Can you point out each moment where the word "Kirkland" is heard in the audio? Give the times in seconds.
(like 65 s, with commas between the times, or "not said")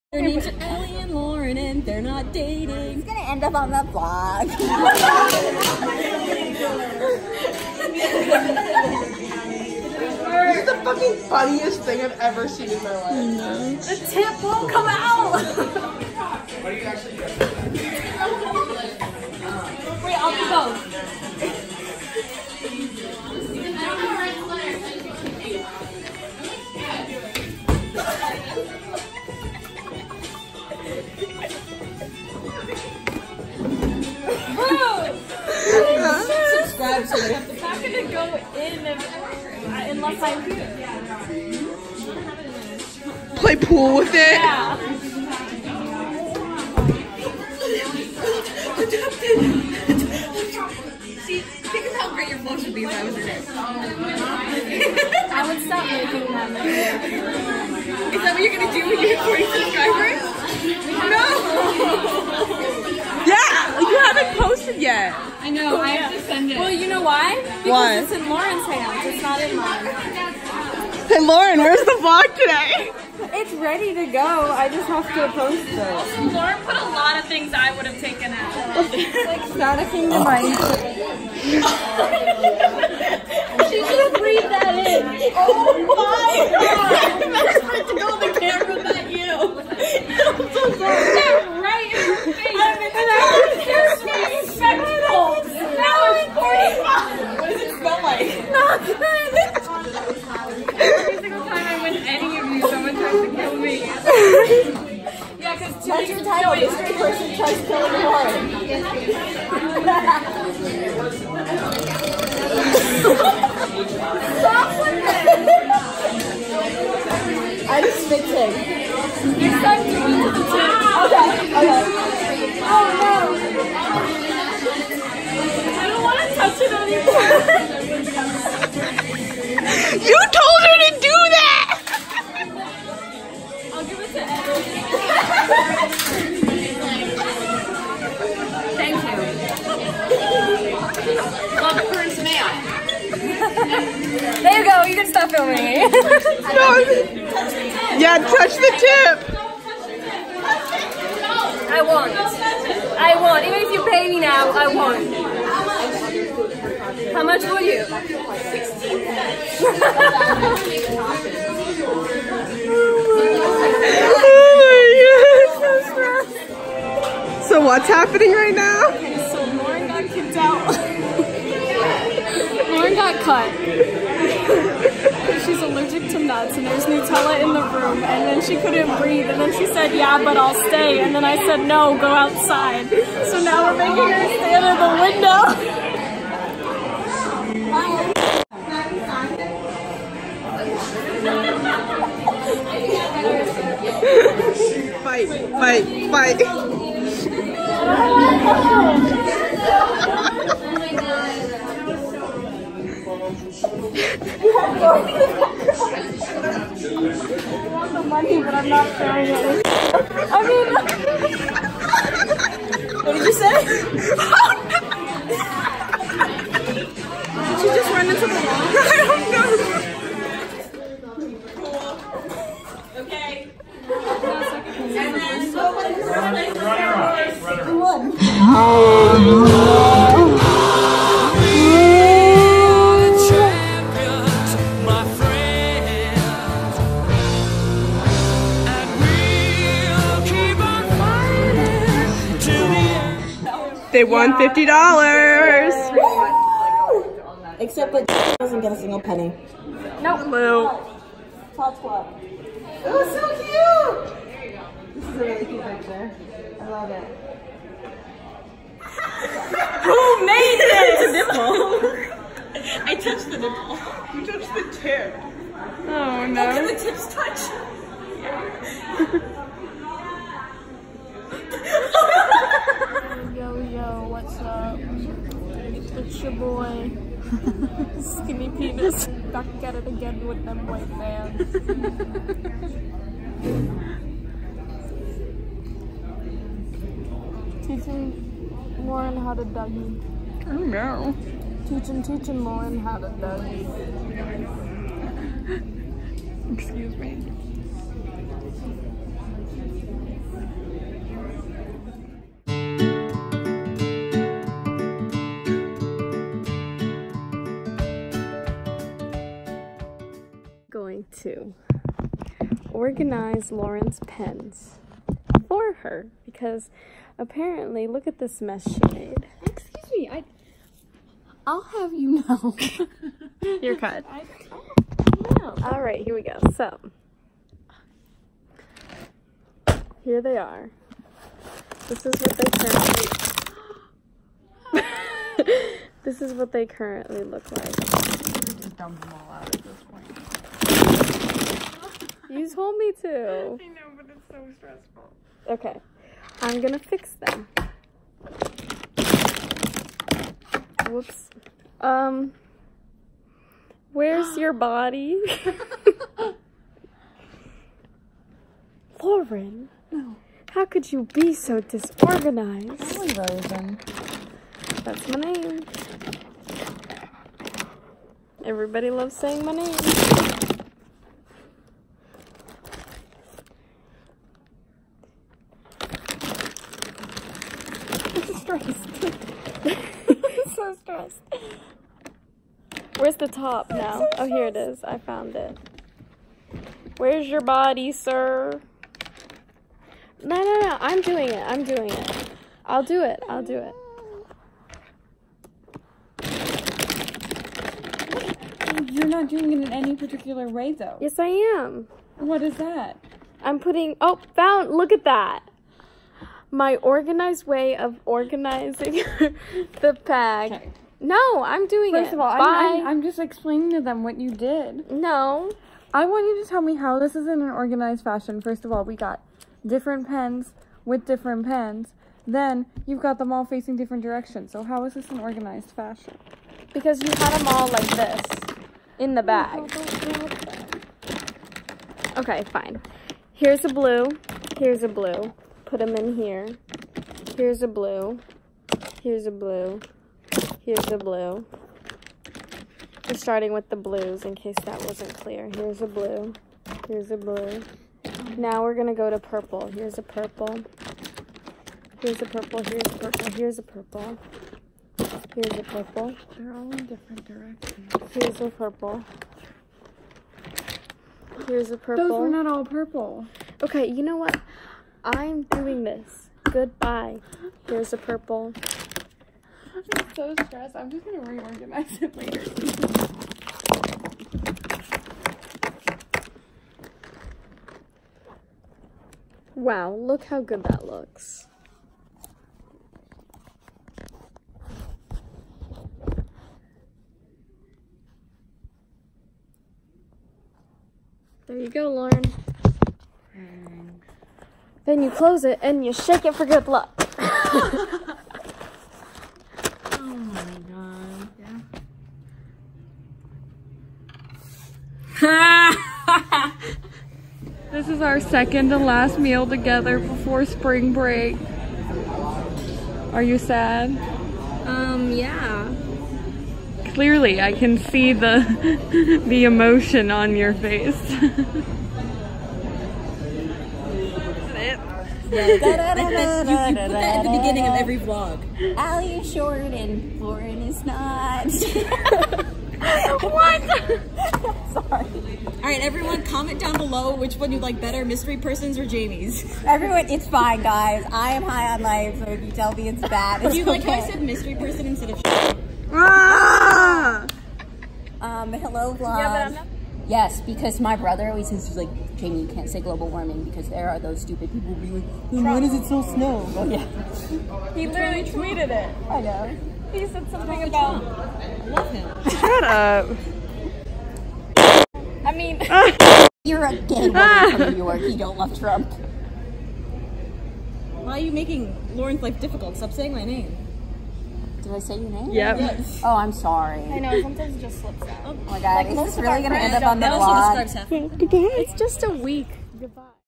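not said.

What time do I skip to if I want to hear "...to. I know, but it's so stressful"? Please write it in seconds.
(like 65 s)
343 s.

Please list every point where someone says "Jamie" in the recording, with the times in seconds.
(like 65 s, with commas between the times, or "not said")
538 s, 552 s.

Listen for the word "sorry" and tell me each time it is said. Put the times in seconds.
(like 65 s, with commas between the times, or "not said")
90 s, 534 s, 576 s.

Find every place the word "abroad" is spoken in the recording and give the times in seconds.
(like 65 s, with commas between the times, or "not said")
not said.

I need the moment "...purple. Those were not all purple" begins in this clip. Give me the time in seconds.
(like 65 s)
461 s.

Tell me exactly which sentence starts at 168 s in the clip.
Okay, so Lauren got kicked out.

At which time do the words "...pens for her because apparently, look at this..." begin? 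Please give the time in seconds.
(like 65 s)
314 s.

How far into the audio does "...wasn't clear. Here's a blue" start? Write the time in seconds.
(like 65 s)
444 s.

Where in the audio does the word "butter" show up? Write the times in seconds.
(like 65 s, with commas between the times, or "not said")
not said.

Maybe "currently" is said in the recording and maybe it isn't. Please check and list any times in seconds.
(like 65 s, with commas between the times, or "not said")
332 s, 336 s.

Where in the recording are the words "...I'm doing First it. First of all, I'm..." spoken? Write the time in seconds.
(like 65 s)
411 s.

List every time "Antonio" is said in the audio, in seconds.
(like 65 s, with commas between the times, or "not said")
not said.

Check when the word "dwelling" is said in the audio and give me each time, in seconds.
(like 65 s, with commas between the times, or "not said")
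not said.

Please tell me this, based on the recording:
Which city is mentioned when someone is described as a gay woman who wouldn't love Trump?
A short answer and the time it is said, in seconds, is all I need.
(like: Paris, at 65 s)
New York, at 567 s.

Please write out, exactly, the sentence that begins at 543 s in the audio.
like how I said mystery person instead of ah!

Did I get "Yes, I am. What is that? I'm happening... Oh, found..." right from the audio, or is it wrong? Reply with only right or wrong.
wrong.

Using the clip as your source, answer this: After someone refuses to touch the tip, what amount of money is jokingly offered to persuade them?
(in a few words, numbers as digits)
16.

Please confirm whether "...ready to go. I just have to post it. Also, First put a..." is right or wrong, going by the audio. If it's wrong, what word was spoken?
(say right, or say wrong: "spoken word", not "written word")
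wrong: "Lauren", not "First".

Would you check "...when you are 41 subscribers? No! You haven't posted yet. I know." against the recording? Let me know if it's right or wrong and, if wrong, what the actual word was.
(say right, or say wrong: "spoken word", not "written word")
wrong: "40", not "41".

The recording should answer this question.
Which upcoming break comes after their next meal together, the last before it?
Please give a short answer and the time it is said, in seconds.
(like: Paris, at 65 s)
Spring break, at 510 s.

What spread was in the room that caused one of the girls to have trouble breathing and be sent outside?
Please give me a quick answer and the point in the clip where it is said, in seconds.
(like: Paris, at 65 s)
Nutella, at 176 s.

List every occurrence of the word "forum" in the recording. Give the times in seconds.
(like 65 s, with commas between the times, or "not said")
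not said.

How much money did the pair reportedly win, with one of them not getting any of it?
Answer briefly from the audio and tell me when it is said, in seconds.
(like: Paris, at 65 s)
$50, at 244 s.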